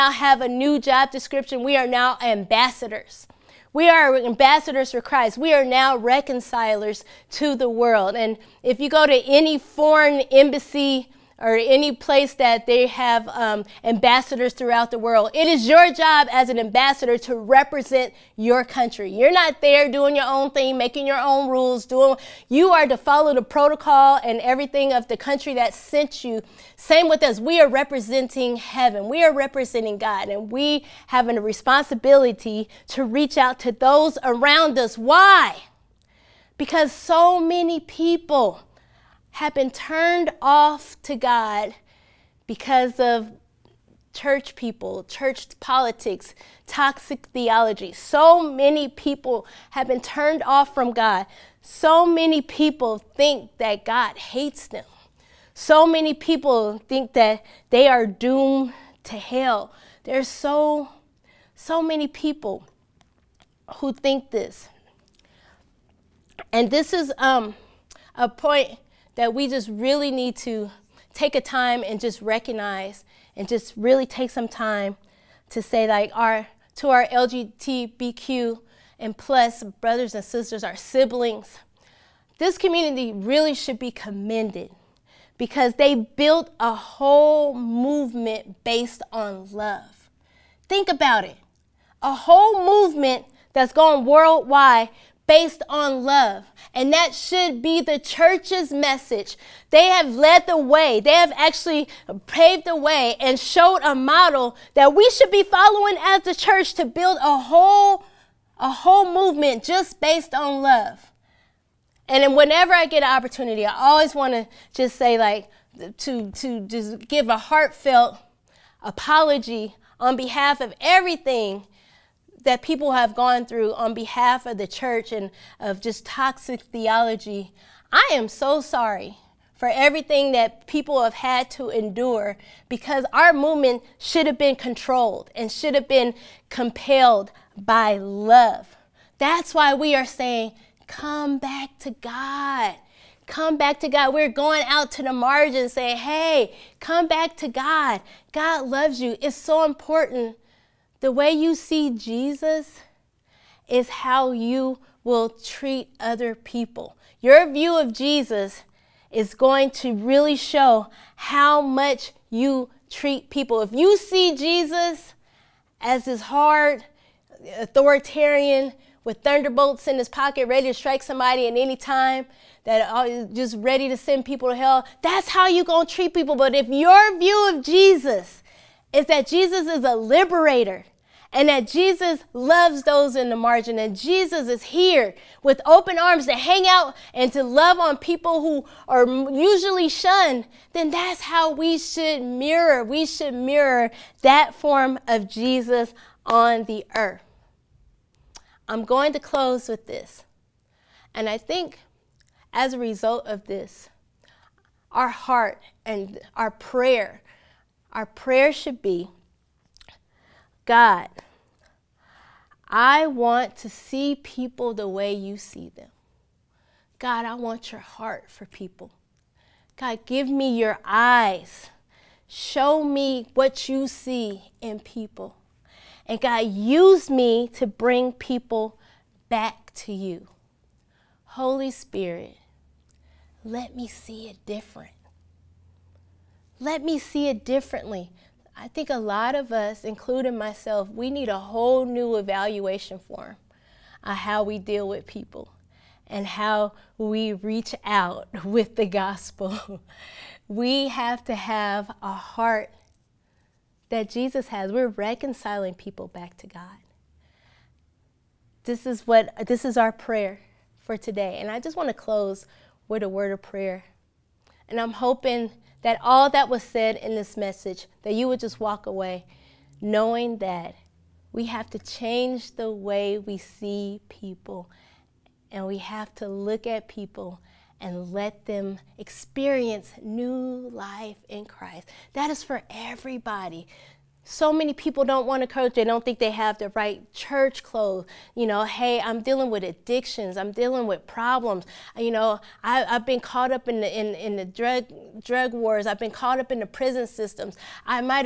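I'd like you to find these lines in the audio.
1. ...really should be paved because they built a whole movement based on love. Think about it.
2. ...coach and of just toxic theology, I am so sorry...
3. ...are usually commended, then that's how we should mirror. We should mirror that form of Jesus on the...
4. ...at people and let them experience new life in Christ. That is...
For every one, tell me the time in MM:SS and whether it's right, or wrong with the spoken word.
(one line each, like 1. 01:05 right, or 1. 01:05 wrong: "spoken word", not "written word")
1. 01:23 wrong: "commended", not "paved"
2. 02:04 wrong: "church", not "coach"
3. 03:08 wrong: "shunned", not "commended"
4. 04:36 right.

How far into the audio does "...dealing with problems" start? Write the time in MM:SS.
04:50.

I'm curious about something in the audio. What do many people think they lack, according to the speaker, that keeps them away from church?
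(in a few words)
The right church clothes.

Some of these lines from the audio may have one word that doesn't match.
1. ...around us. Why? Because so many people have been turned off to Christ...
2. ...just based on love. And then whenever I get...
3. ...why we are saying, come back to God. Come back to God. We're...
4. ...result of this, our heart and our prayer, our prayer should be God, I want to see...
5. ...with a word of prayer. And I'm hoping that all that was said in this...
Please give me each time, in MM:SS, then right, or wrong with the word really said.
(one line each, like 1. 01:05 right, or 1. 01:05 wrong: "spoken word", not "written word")
1. 00:34 wrong: "God", not "Christ"
2. 01:49 right
3. 02:19 right
4. 03:22 right
5. 04:22 right.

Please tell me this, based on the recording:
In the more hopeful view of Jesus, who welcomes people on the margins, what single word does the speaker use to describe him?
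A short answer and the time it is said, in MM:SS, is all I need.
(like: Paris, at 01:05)
Liberator, at 02:59.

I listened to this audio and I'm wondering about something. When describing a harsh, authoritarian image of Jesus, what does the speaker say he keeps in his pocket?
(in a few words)
Thunderbolts.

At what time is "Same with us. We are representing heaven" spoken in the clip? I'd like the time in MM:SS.
00:26.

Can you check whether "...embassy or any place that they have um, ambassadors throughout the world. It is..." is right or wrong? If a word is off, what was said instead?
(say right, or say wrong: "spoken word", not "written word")
right.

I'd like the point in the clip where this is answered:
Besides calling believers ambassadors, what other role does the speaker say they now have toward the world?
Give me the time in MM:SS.
00:05.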